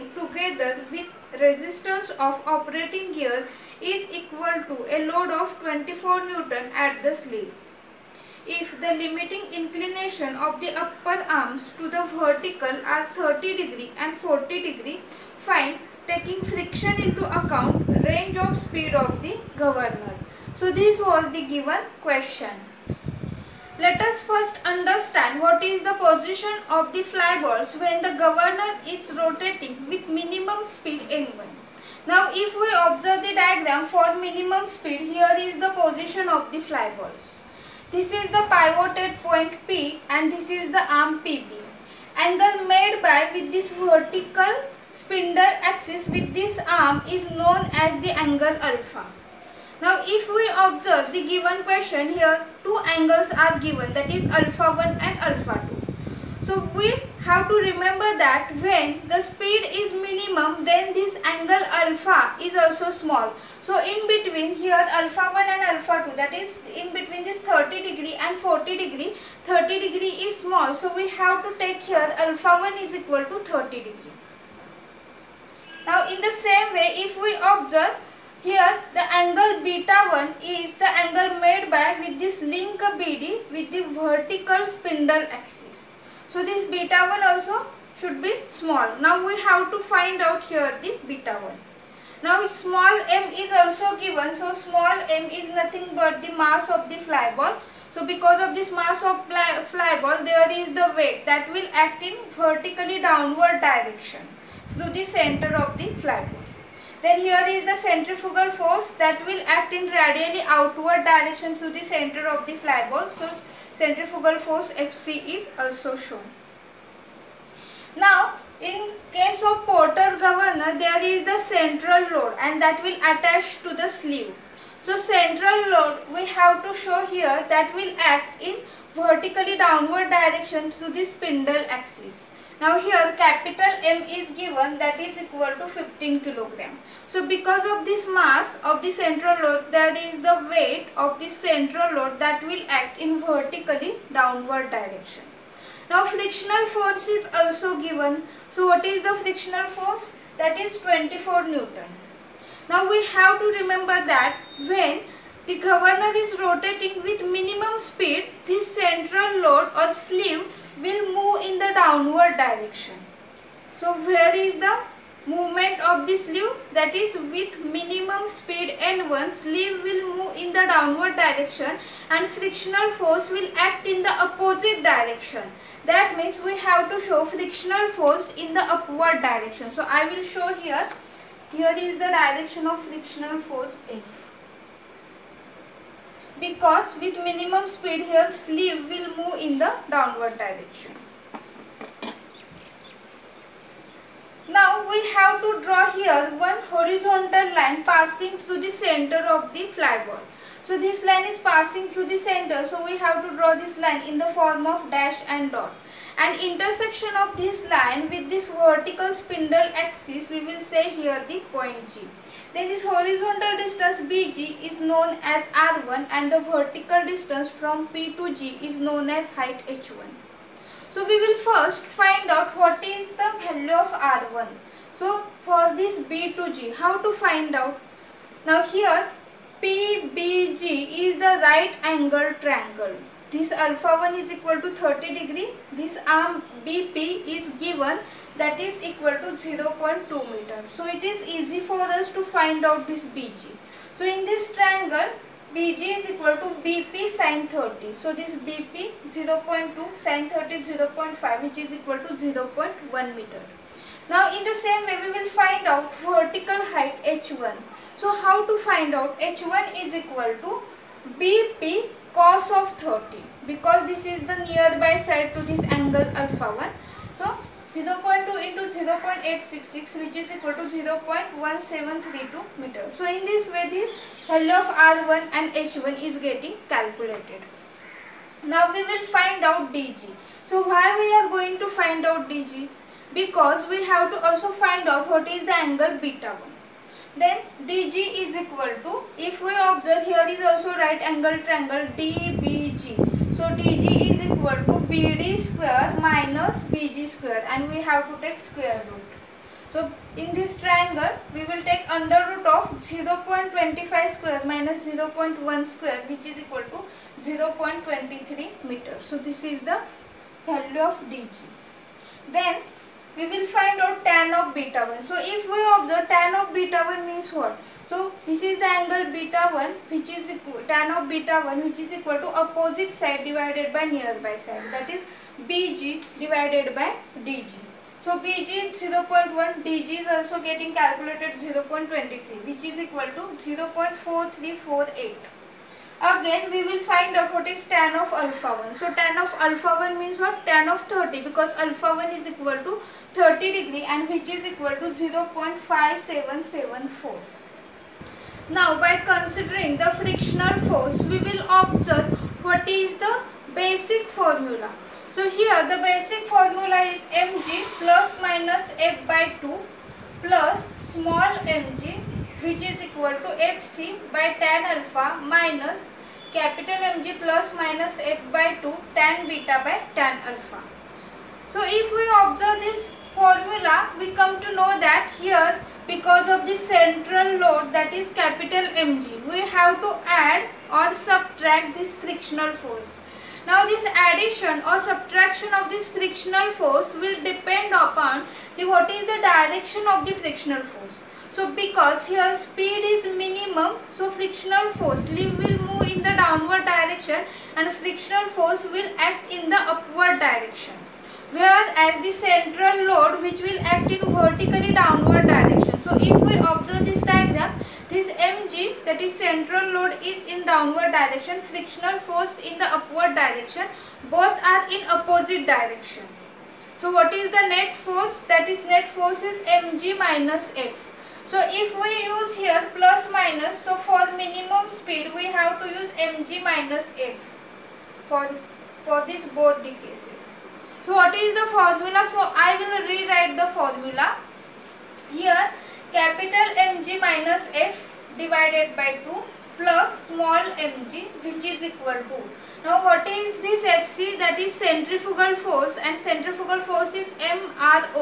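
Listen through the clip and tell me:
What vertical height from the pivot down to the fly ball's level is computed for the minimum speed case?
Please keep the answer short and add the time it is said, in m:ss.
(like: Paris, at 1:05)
0.1732 meter, at 4:30.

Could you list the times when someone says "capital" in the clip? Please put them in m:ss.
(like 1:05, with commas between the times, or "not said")
2:13, 6:06, 6:18, 7:15.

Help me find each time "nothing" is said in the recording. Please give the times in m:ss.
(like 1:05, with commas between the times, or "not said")
1:35.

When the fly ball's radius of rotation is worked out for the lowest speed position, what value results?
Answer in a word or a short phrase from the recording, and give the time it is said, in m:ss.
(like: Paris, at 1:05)
0.1 meter, at 4:12.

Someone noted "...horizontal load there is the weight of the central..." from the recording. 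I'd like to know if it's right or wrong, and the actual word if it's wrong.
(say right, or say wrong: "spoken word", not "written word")
wrong: "central", not "horizontal".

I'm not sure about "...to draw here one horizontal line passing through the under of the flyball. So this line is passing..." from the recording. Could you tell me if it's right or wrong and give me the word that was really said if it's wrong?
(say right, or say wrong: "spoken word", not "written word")
wrong: "center", not "under".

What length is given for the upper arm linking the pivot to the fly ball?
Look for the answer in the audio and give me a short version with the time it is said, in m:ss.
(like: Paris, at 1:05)
0.2 meter, at 3:59.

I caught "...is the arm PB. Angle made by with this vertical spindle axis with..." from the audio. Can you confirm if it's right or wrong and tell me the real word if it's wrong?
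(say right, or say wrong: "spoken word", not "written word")
right.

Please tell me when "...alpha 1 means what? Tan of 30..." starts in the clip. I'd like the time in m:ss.
5:39.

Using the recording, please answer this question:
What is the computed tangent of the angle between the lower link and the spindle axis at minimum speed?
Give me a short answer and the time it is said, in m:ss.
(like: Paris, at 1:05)
0.4348, at 5:33.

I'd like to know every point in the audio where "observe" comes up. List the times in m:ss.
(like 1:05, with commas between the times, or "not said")
0:32, 0:50, 1:17, 4:49, 5:15, 5:51, 6:12, 6:46.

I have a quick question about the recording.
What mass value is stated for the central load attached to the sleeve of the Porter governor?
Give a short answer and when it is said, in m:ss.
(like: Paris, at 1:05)
15 kilogram, at 2:15.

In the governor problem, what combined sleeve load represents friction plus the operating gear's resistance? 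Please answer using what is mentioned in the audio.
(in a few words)
24 N.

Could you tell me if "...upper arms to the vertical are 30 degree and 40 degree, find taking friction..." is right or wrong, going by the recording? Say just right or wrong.
right.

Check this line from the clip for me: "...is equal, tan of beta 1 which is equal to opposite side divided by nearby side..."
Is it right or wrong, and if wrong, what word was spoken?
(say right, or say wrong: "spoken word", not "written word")
right.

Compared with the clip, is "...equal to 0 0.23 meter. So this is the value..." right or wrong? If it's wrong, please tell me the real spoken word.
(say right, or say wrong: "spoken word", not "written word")
right.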